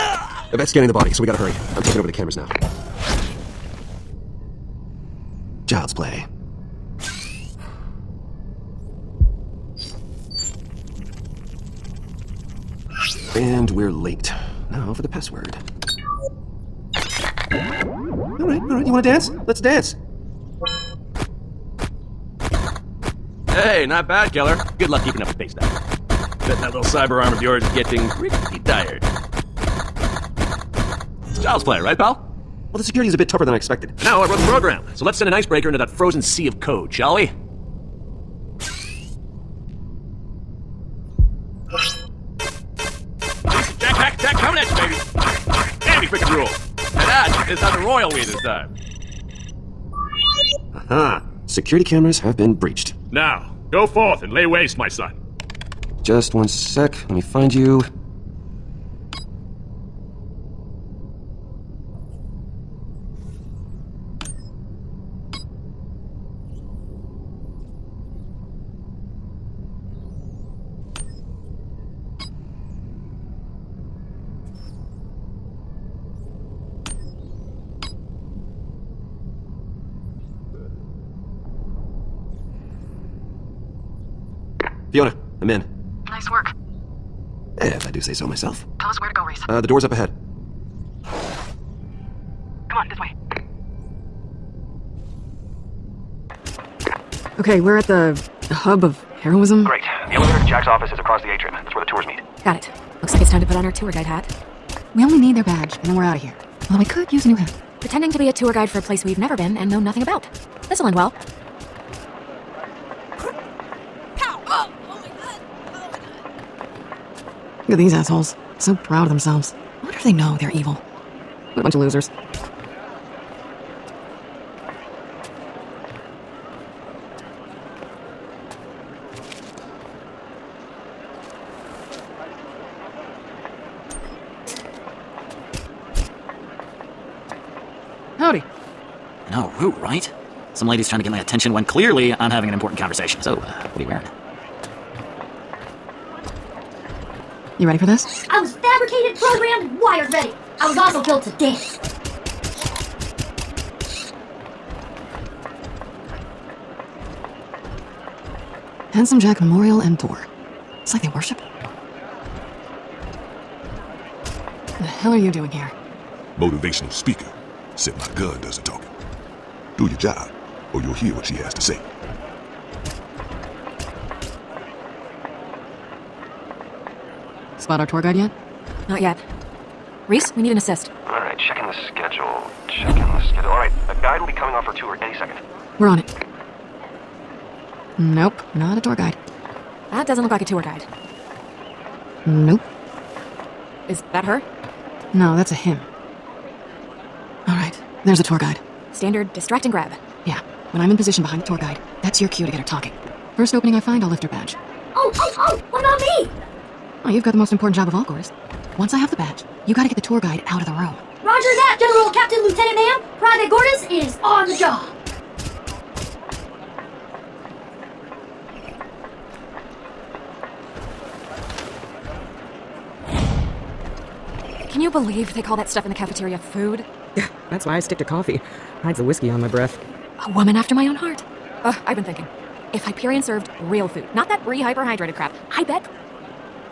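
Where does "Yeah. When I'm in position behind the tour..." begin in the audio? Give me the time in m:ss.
3:20.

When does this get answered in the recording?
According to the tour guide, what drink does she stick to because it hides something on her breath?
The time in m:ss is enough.
3:48.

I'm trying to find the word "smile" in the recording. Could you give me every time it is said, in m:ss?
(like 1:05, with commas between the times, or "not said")
not said.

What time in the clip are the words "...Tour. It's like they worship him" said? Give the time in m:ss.
2:39.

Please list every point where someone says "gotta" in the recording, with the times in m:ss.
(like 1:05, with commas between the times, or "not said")
0:01, 3:29.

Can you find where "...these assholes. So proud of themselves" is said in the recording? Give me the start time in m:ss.
1:57.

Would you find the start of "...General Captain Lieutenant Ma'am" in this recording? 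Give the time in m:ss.
3:31.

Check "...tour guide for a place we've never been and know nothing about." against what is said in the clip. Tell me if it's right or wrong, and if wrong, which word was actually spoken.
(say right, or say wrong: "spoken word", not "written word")
right.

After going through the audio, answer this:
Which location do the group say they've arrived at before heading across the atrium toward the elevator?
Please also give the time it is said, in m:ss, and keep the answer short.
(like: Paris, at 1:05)
hub of heroism, at 1:38.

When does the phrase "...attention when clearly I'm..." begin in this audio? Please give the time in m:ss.
2:21.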